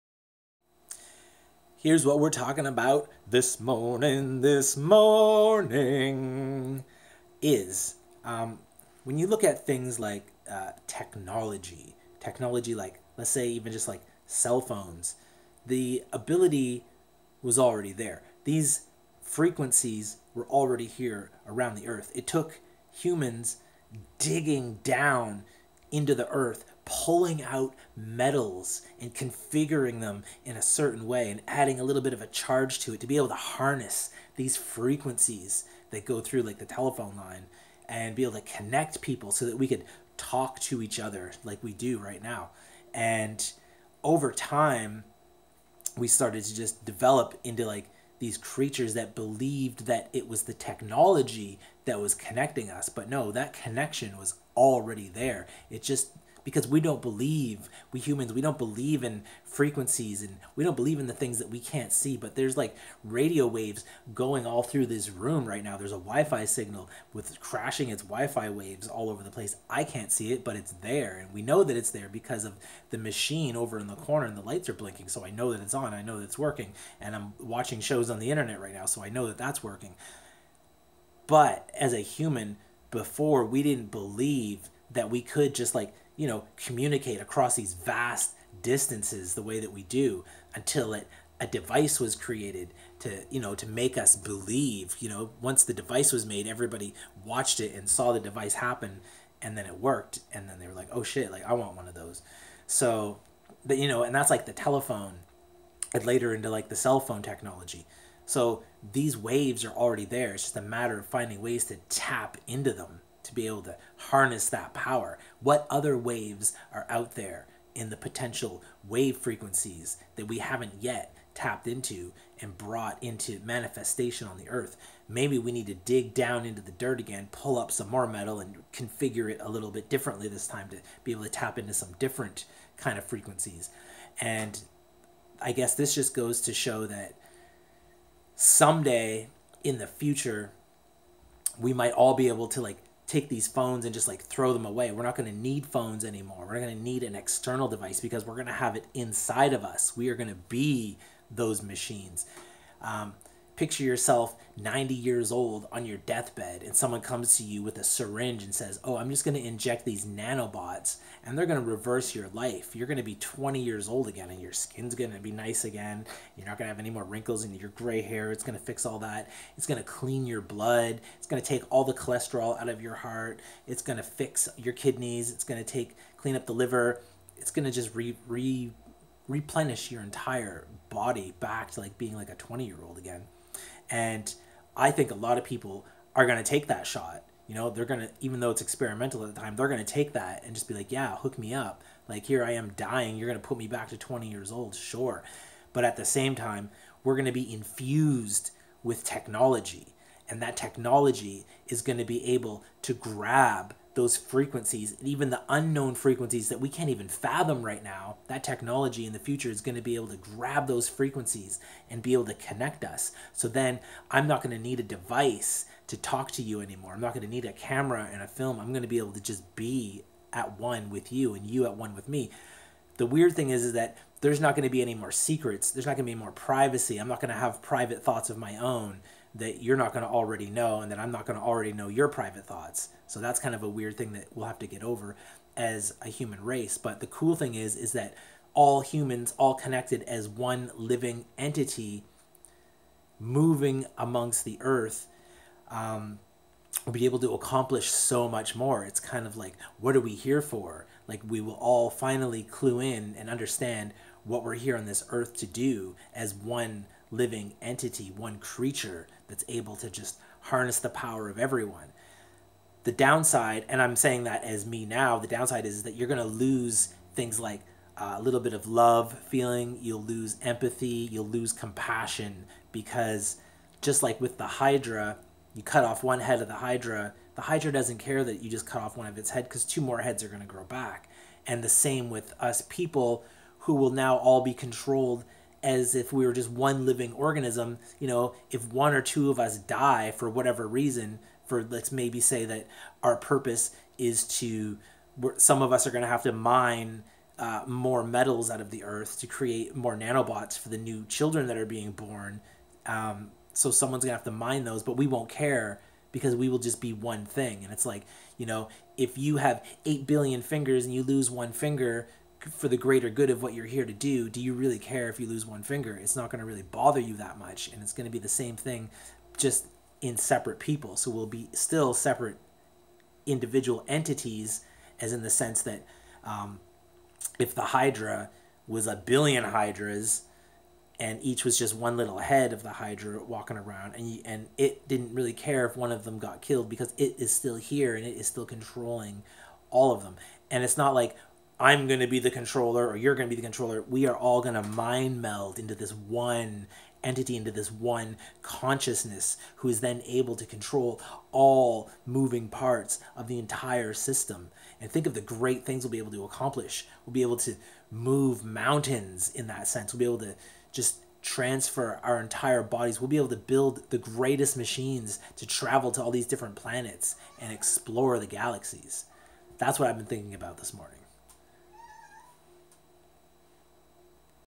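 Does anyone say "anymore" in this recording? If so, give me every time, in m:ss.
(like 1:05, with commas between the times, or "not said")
2:26, 3:36.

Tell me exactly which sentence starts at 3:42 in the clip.
The weird thing is, is that there's not going to be any more secrets.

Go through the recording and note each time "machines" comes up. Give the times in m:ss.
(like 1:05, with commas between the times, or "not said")
1:12, 2:31, 6:04.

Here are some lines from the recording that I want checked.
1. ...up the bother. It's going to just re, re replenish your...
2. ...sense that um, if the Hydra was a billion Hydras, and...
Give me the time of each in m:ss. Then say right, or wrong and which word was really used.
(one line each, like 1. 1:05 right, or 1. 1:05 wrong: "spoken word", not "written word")
1. 2:56 wrong: "liver", not "bother"
2. 5:25 right.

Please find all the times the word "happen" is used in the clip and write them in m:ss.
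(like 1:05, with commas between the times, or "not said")
1:38.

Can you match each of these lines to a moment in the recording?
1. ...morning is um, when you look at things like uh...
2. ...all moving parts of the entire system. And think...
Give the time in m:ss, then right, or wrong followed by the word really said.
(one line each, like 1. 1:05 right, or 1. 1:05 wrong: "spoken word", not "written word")
1. 0:04 right
2. 5:51 right.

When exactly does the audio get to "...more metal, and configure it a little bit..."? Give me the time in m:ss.
2:07.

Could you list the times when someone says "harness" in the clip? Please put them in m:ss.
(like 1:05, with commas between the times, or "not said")
0:33, 1:53, 4:20.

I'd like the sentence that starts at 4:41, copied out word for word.
And the same with us people who will now all be controlled as if we were just one living organism.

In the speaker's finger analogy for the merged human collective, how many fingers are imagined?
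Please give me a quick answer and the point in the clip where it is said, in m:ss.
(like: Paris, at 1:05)
8 billion, at 5:09.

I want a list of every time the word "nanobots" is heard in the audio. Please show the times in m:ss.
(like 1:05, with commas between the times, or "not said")
2:40, 4:59.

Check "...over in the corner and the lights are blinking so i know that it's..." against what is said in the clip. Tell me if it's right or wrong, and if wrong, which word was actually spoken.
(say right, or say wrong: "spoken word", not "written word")
right.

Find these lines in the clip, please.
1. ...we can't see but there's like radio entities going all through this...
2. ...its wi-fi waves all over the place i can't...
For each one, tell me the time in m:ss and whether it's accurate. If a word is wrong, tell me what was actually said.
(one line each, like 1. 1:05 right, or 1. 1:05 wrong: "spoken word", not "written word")
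1. 1:01 wrong: "waves", not "entities"
2. 1:07 right.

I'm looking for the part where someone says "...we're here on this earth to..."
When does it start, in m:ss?
4:14.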